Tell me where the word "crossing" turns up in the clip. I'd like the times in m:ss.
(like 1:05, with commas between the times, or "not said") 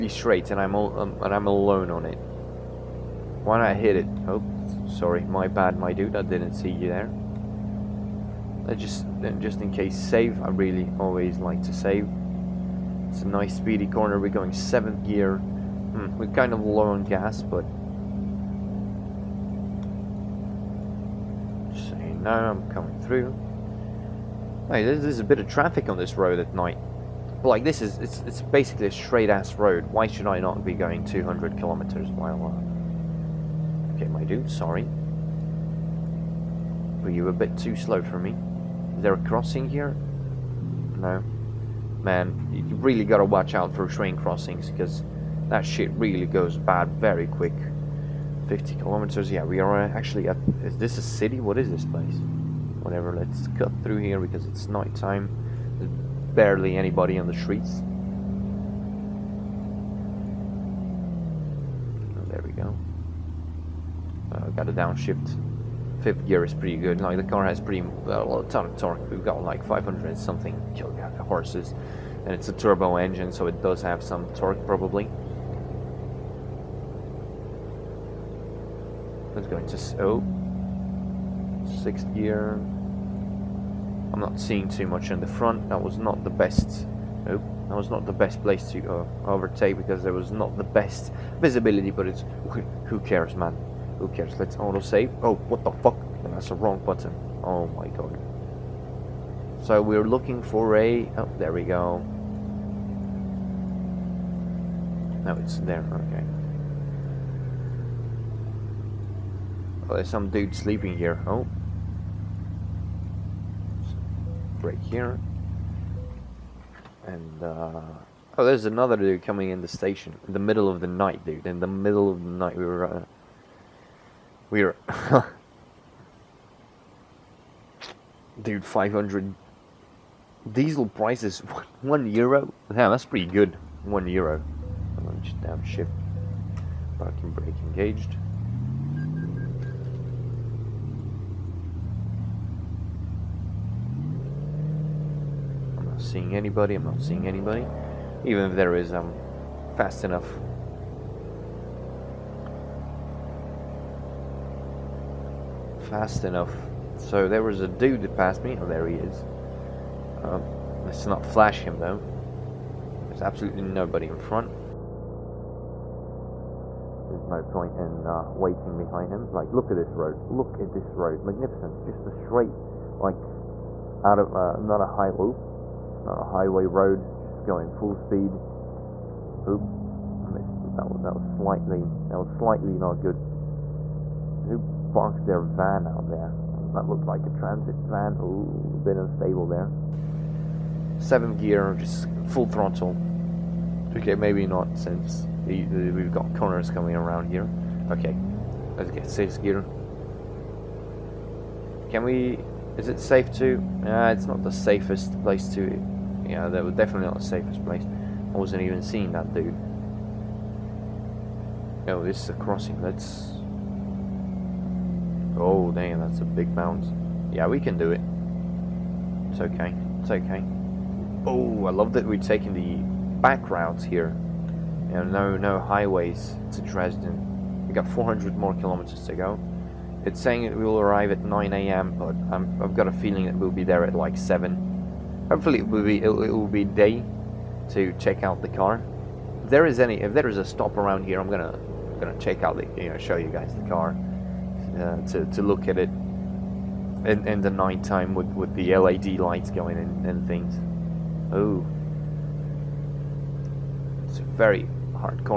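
0:39, 0:44, 3:32.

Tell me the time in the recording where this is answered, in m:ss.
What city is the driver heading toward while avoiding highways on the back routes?
3:46.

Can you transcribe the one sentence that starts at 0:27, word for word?
Like this is it's it's basically a straight ass road.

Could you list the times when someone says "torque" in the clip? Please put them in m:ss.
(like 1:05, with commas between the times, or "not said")
1:08, 1:14.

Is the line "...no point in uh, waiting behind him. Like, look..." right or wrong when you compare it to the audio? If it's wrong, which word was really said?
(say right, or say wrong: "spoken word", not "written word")
right.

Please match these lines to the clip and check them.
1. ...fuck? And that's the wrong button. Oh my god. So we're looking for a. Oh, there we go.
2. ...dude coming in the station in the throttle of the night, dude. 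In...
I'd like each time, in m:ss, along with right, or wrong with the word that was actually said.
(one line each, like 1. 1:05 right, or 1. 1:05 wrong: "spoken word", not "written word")
1. 1:35 right
2. 1:58 wrong: "middle", not "throttle".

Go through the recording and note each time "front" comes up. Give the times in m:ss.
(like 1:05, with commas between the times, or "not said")
1:25, 2:44.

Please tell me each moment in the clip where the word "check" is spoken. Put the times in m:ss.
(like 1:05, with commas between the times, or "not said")
3:57, 4:02.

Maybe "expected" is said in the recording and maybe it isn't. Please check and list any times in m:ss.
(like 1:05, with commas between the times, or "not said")
not said.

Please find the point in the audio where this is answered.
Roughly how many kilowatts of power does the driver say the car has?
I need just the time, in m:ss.
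1:09.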